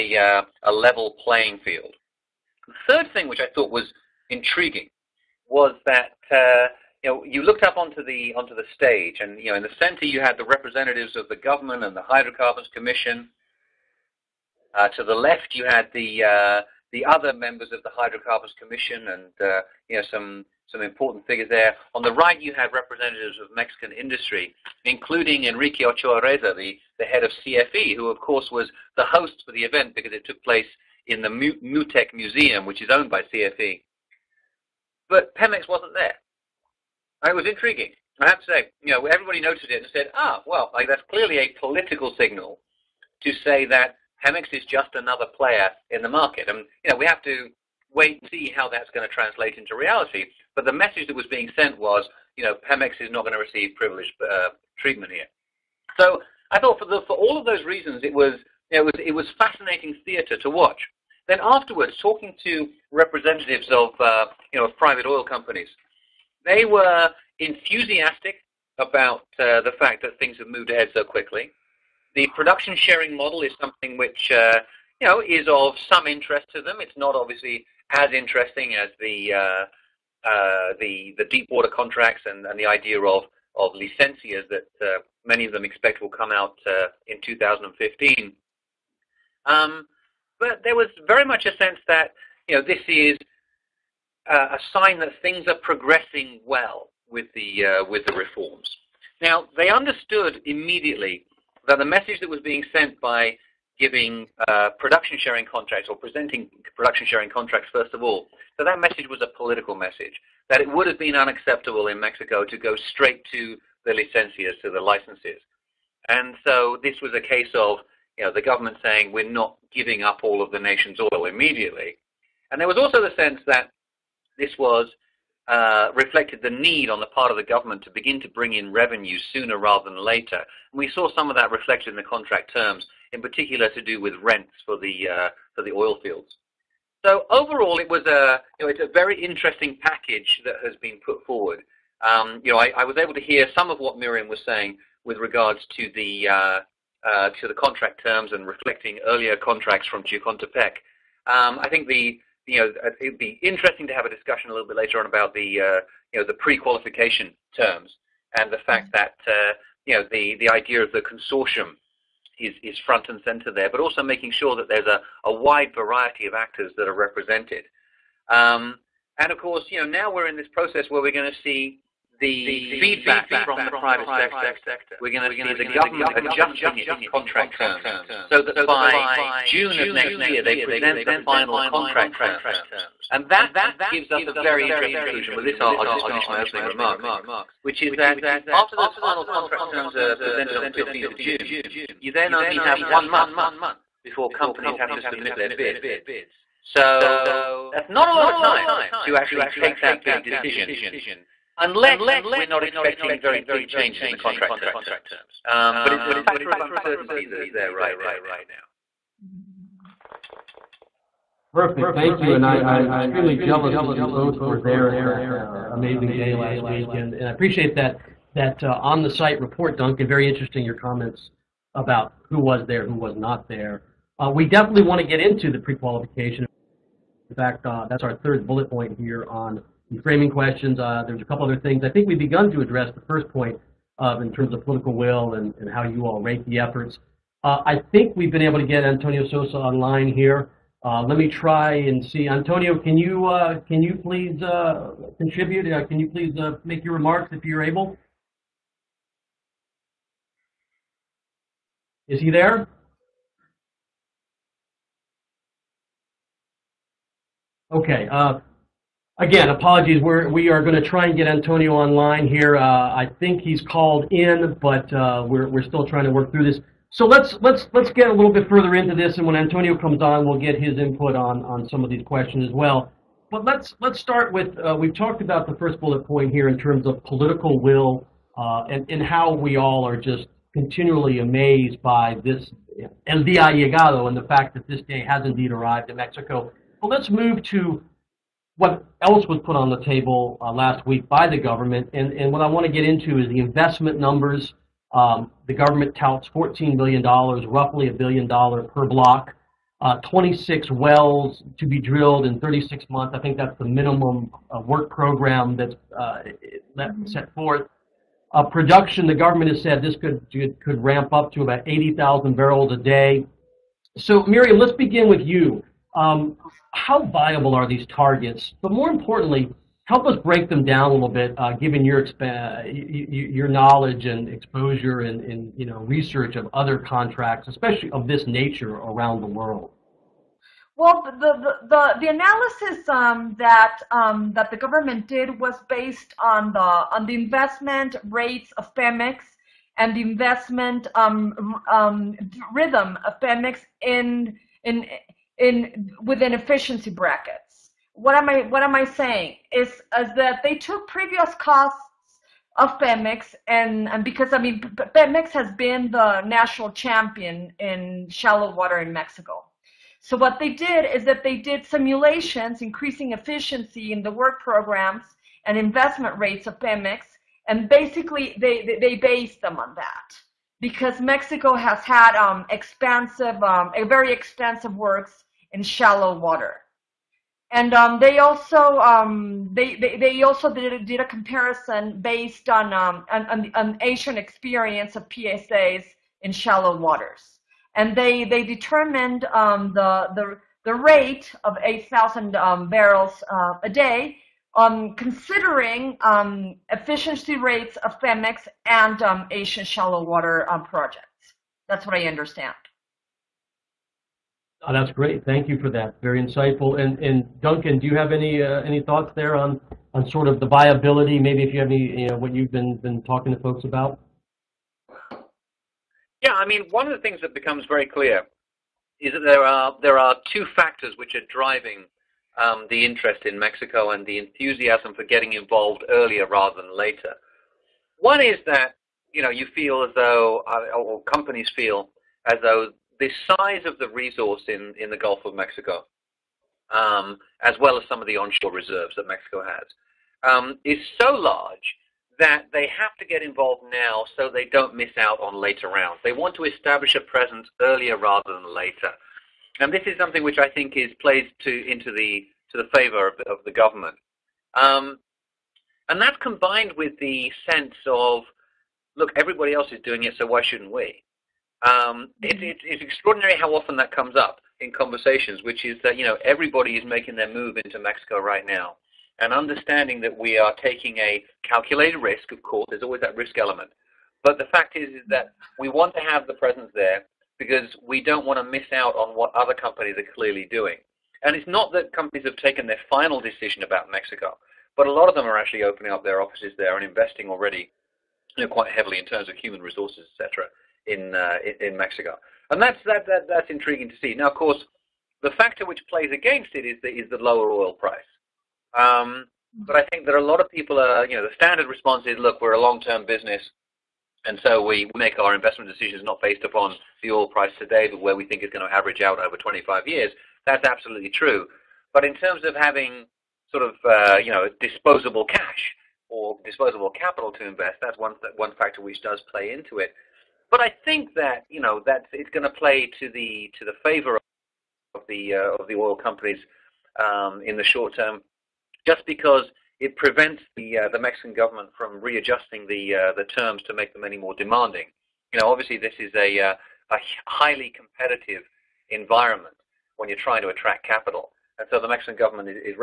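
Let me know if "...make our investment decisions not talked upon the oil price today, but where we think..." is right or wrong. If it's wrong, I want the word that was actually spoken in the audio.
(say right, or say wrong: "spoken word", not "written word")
wrong: "based", not "talked".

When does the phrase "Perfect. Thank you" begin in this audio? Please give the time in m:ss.
3:31.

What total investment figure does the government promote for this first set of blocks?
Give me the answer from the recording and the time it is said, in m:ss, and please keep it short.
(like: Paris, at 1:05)
$14 billion, at 4:56.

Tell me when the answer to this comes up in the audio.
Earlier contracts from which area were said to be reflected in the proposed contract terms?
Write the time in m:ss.
2:30.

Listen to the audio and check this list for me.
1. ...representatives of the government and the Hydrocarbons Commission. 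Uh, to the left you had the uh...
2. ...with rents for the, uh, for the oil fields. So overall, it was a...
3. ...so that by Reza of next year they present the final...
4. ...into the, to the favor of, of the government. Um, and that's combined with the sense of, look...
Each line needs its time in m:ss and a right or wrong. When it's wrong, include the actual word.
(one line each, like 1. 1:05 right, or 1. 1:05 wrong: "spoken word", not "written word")
1. 0:10 right
2. 2:13 right
3. 2:58 wrong: "June", not "Reza"
4. 7:31 right.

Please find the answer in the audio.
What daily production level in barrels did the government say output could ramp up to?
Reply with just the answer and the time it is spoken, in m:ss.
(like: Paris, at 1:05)
80,000, at 5:11.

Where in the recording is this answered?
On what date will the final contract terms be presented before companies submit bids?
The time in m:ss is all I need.
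3:10.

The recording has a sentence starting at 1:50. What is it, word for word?
That it would have been unacceptable in Mexico to go straight to the licencias, to the licenses.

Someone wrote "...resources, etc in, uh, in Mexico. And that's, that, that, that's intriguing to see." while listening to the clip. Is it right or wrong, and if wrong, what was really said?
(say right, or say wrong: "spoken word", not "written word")
right.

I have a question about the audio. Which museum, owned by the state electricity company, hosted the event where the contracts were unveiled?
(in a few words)
Mutec Museum.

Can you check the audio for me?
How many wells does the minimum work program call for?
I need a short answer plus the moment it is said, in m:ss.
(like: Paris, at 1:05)
26, at 5:00.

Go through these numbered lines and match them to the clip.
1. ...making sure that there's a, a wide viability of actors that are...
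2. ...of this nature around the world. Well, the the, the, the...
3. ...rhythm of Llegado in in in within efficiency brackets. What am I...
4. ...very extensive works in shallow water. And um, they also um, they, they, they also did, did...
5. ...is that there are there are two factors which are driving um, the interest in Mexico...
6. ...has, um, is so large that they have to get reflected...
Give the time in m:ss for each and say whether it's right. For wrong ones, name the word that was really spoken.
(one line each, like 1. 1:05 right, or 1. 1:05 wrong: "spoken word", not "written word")
1. 2:44 wrong: "variety", not "viability"
2. 5:27 right
3. 5:42 wrong: "Pemex", not "Llegado"
4. 6:13 right
5. 6:58 right
6. 7:19 wrong: "involved", not "reflected".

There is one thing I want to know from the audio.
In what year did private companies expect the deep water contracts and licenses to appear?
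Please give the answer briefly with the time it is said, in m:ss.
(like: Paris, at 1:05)
2015, at 1:27.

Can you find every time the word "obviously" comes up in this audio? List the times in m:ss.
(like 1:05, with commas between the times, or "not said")
1:17, 8:55.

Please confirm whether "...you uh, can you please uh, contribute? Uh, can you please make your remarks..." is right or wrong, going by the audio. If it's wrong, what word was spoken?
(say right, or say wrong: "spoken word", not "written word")
right.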